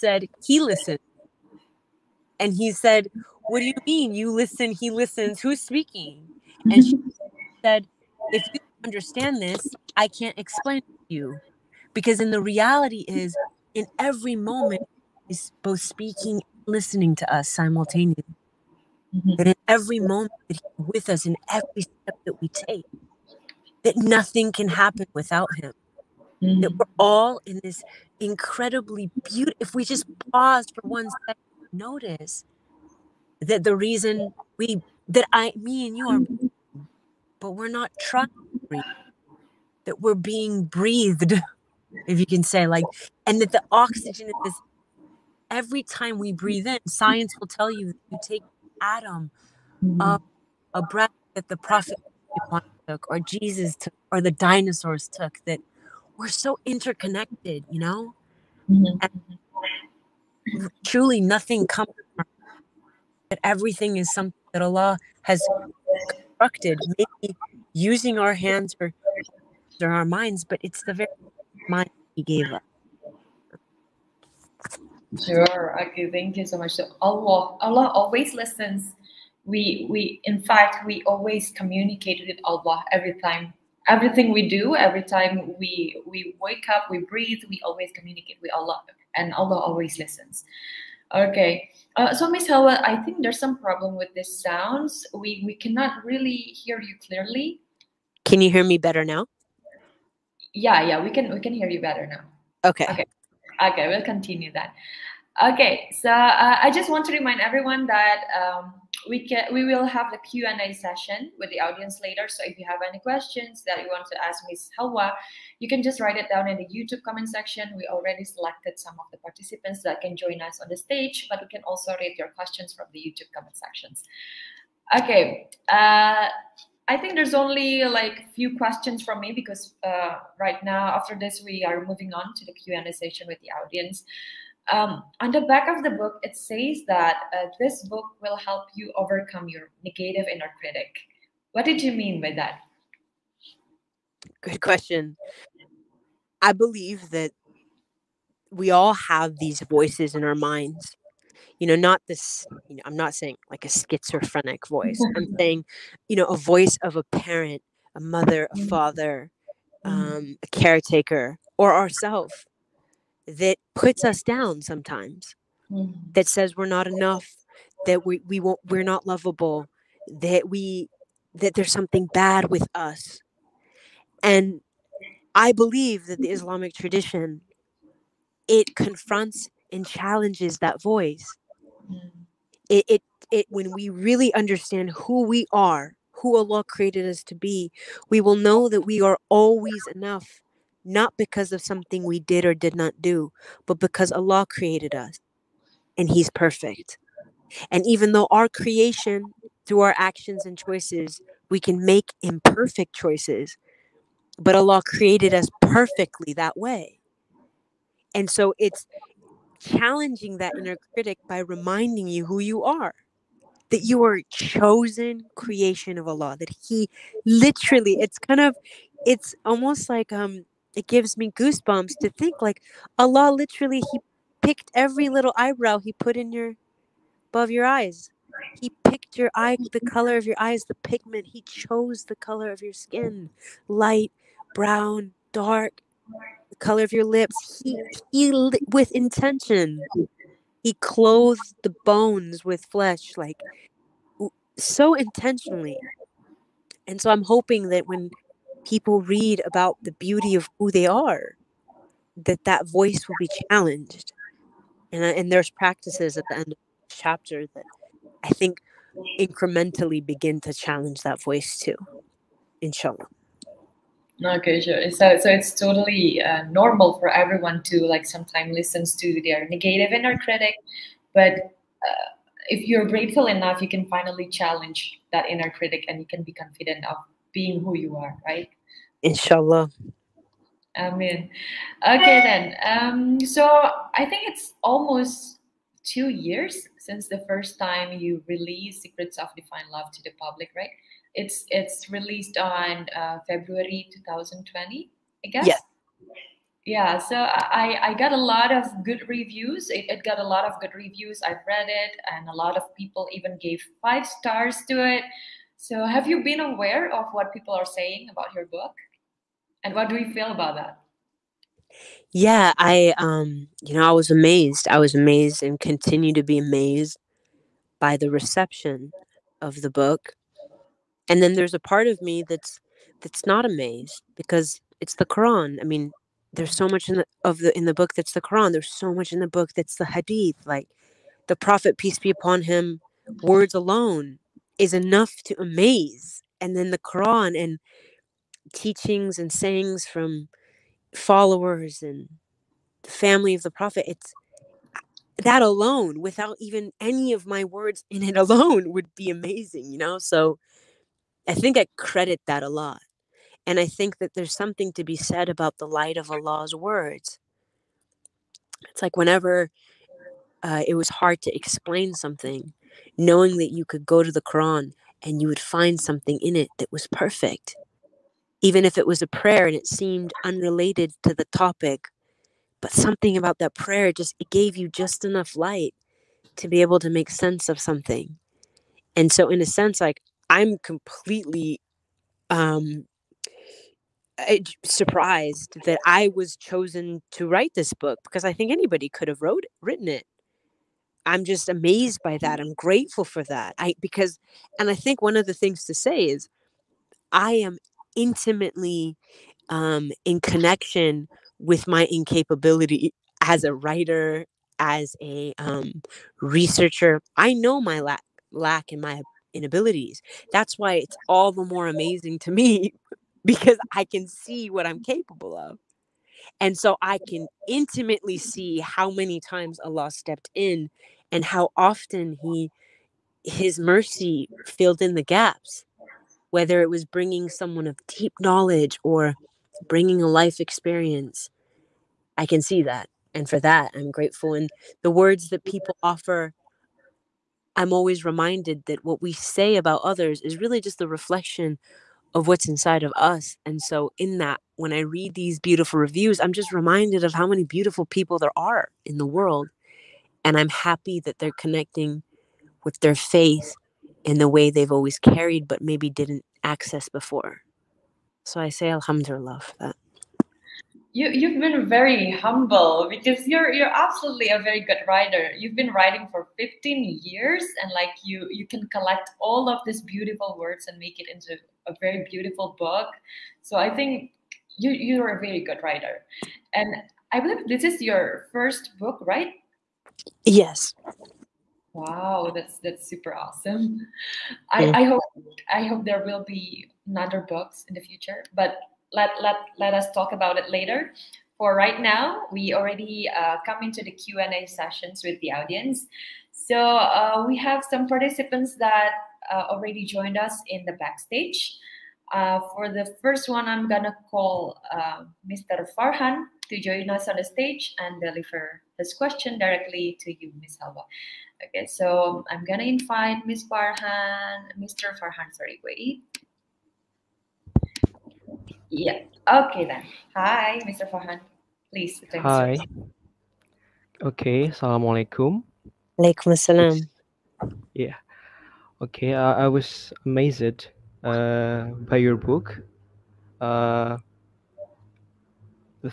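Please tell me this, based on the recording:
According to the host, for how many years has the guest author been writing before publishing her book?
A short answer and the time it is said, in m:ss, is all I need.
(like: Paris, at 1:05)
15, at 7:46.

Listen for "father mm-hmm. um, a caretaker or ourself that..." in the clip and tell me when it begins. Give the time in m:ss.
2:38.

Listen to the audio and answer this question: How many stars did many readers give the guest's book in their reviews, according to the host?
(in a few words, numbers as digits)
5.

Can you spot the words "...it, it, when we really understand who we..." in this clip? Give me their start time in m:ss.
3:02.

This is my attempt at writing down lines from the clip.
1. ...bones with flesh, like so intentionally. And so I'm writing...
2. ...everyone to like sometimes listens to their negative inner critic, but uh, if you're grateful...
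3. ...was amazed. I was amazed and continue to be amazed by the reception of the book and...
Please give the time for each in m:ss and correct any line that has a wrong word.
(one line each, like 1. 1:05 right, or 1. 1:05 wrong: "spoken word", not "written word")
1. 4:01 wrong: "hoping", not "writing"
2. 4:27 right
3. 5:13 right.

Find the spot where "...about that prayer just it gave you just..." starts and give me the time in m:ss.
6:13.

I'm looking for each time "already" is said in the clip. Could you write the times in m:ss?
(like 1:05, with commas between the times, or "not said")
1:57, 8:12, 8:19.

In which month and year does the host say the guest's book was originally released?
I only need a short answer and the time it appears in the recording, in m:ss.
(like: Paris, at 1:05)
February 2020, at 4:53.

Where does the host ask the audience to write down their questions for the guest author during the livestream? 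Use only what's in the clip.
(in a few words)
YouTube comment section.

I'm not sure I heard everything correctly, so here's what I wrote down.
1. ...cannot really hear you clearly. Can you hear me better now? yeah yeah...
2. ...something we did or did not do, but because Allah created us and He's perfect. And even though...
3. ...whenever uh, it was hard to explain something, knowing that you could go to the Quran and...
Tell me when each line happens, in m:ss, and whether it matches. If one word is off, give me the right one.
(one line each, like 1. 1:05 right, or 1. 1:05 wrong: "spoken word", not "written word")
1. 1:35 right
2. 3:11 right
3. 5:58 right.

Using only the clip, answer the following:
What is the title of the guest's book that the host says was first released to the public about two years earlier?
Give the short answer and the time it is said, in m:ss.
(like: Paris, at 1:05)
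Secrets of Divine Love, at 4:48.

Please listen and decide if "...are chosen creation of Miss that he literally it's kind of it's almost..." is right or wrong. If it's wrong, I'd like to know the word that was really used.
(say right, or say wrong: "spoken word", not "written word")
wrong: "Allah", not "Miss".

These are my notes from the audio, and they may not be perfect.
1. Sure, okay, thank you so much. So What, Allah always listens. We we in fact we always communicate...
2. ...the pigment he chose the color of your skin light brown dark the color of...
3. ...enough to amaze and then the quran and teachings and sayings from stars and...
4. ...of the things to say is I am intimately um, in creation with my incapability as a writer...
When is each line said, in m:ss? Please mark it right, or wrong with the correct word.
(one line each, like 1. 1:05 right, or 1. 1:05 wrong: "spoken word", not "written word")
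1. 1:15 wrong: "Allah", not "What"
2. 3:50 right
3. 5:34 wrong: "followers", not "stars"
4. 6:35 wrong: "connection", not "creation".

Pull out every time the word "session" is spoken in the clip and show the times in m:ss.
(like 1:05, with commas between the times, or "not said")
1:50, 2:12, 8:14.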